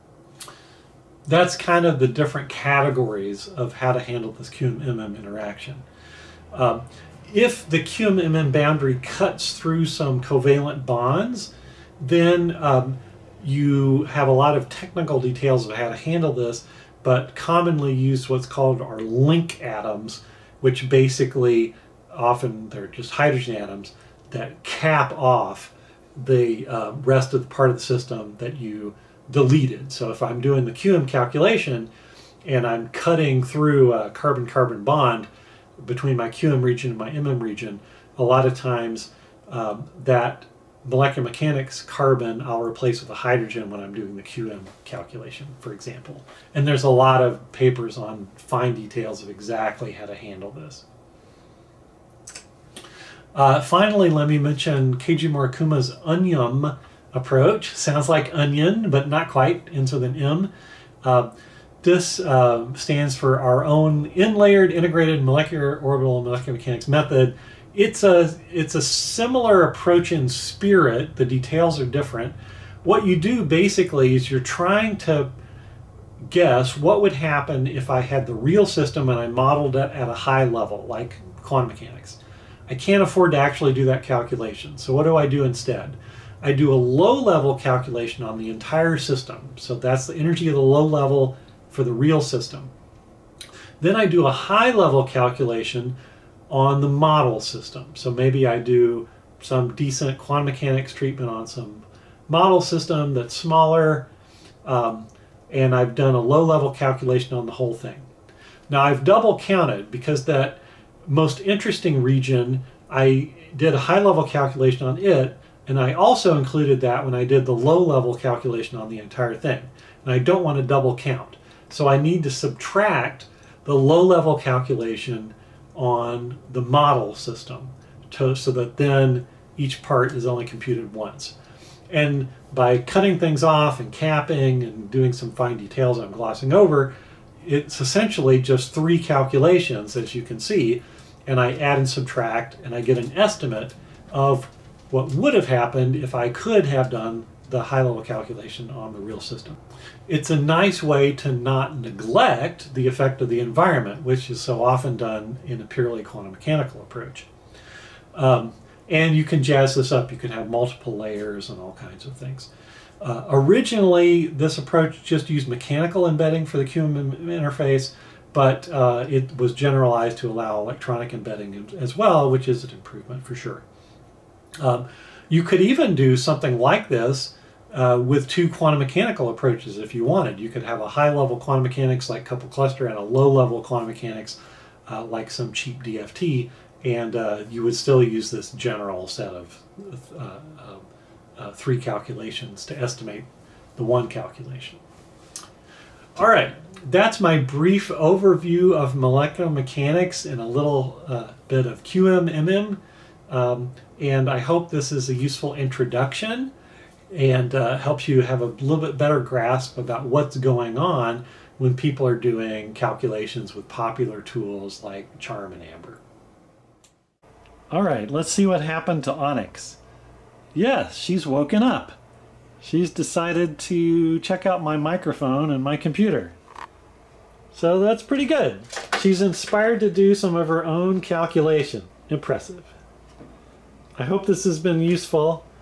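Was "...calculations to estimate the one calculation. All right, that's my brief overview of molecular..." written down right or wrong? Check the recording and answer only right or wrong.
right.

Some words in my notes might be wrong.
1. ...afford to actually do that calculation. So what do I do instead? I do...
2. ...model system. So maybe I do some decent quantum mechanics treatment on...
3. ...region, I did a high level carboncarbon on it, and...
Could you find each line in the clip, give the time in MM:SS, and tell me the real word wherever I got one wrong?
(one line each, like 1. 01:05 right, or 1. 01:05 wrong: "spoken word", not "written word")
1. 01:23 right
2. 01:36 right
3. 01:52 wrong: "calculation", not "carboncarbon".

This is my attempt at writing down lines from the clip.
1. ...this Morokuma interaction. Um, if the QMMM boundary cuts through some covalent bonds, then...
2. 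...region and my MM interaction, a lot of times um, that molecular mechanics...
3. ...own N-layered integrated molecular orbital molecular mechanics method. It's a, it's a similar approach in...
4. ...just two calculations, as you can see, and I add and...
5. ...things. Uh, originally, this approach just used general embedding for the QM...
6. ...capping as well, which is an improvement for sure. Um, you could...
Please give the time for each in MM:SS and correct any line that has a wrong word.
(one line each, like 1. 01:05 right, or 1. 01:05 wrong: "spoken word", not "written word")
1. 00:04 wrong: "QMMM", not "Morokuma"
2. 00:36 wrong: "region", not "interaction"
3. 01:03 right
4. 02:18 wrong: "three", not "two"
5. 02:42 wrong: "mechanical", not "general"
6. 02:51 wrong: "embedding", not "capping".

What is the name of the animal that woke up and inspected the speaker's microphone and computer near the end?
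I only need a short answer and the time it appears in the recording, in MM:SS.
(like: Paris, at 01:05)
Onyx, at 03:39.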